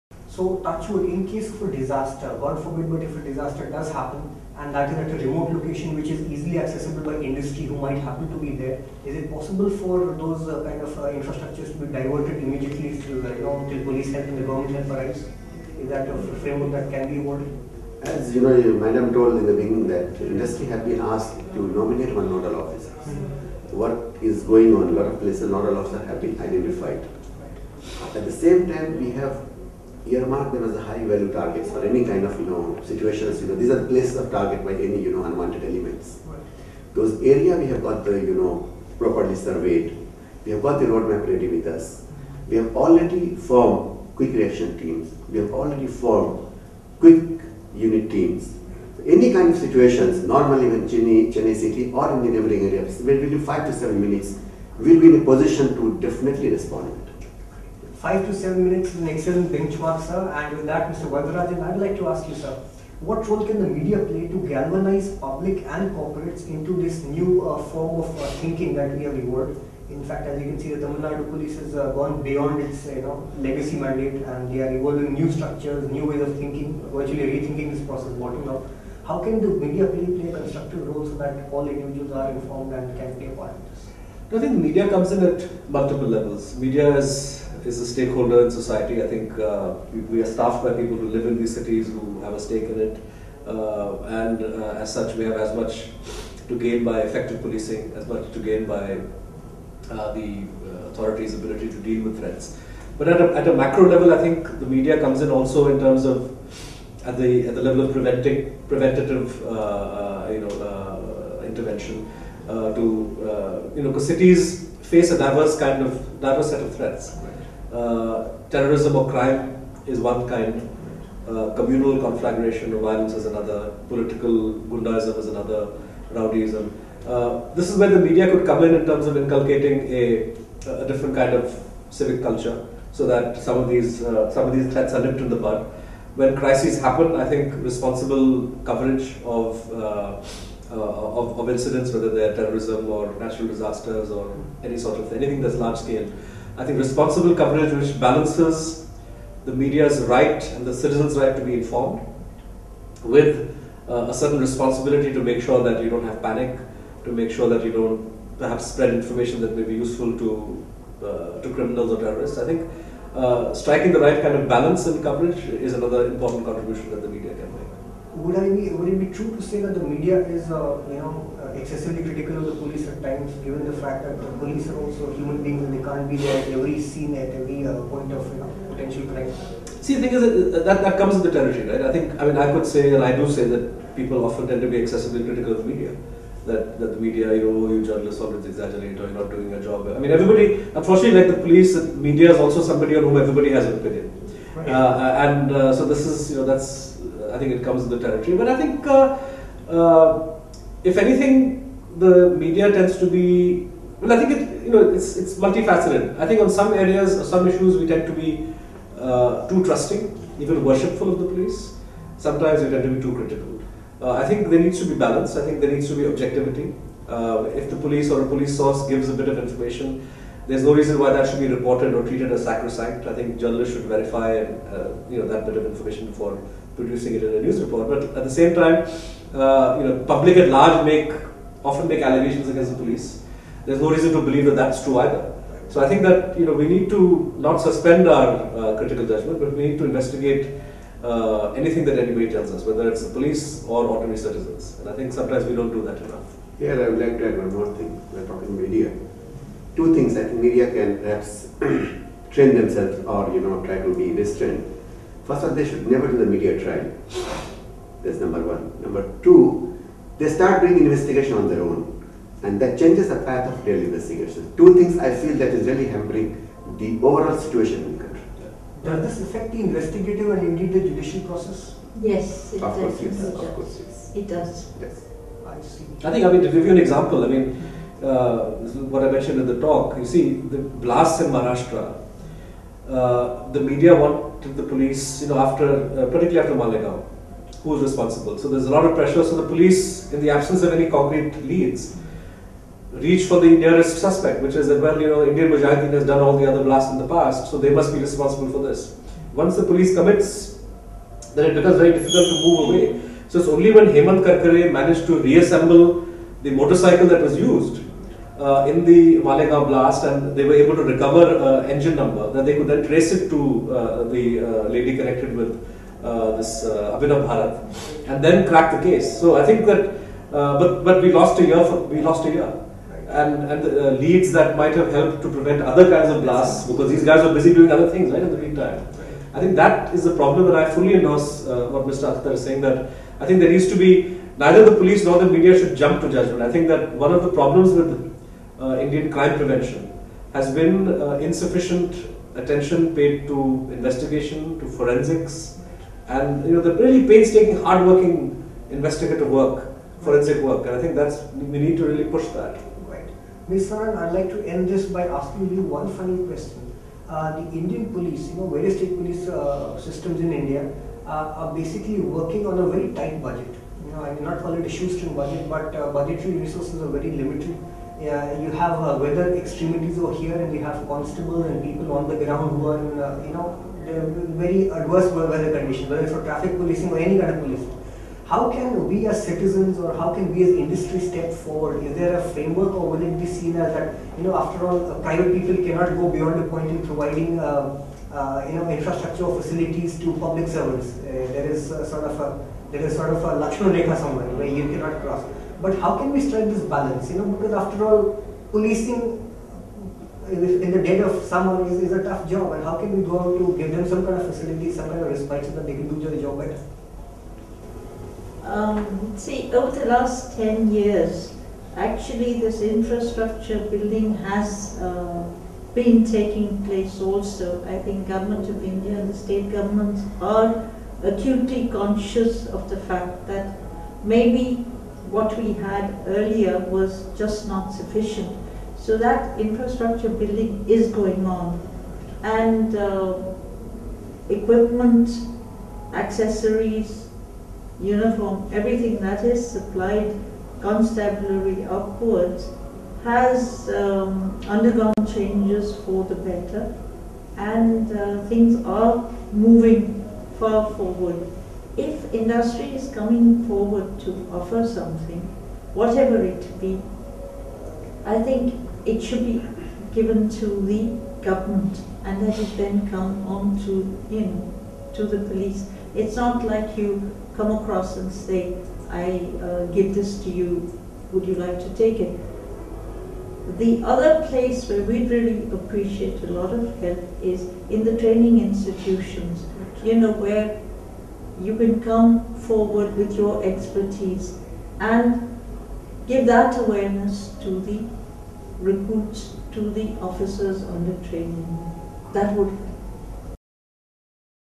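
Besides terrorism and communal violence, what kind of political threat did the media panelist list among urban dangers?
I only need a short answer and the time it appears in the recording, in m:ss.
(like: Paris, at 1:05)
political gundaism, at 2:03.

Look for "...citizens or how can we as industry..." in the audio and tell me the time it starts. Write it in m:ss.
6:19.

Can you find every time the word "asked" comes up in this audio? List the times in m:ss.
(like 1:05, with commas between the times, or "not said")
0:21.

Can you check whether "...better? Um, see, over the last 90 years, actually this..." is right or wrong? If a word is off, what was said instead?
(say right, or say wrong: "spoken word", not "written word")
wrong: "10", not "90".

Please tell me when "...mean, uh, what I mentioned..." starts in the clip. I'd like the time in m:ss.
4:37.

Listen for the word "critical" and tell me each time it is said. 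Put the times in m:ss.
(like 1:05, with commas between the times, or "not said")
2:52, 3:05, 3:33, 3:58.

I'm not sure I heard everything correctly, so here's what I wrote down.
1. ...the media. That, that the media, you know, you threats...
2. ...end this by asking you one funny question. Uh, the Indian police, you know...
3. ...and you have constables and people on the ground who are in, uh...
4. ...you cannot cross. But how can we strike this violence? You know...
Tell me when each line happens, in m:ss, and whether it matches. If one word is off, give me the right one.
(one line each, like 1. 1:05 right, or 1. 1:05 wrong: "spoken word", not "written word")
1. 3:05 wrong: "journalists", not "threats"
2. 5:54 right
3. 6:10 right
4. 6:34 wrong: "balance", not "violence".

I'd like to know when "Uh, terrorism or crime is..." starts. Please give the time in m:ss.
1:57.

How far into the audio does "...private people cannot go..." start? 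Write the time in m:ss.
6:25.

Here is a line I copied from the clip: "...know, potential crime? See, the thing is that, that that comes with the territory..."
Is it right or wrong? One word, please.
right.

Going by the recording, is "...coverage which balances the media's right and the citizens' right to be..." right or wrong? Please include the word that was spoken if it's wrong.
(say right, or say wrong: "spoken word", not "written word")
right.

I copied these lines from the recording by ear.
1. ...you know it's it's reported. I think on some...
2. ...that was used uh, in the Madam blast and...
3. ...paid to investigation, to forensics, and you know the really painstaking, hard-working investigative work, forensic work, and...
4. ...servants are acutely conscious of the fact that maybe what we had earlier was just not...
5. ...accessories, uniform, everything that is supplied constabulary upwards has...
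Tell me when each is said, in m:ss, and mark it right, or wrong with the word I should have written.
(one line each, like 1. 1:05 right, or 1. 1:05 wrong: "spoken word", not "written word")
1. 3:24 wrong: "multifaceted", not "reported"
2. 5:07 wrong: "Malegaon", not "Madam"
3. 5:42 right
4. 6:59 wrong: "governments", not "servants"
5. 7:15 right.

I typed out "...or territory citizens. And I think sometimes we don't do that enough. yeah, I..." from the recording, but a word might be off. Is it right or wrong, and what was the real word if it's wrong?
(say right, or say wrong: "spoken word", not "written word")
wrong: "ordinary", not "territory".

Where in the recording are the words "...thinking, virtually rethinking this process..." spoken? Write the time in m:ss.
1:16.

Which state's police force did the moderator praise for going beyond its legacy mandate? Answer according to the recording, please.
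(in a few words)
Tamil Nadu.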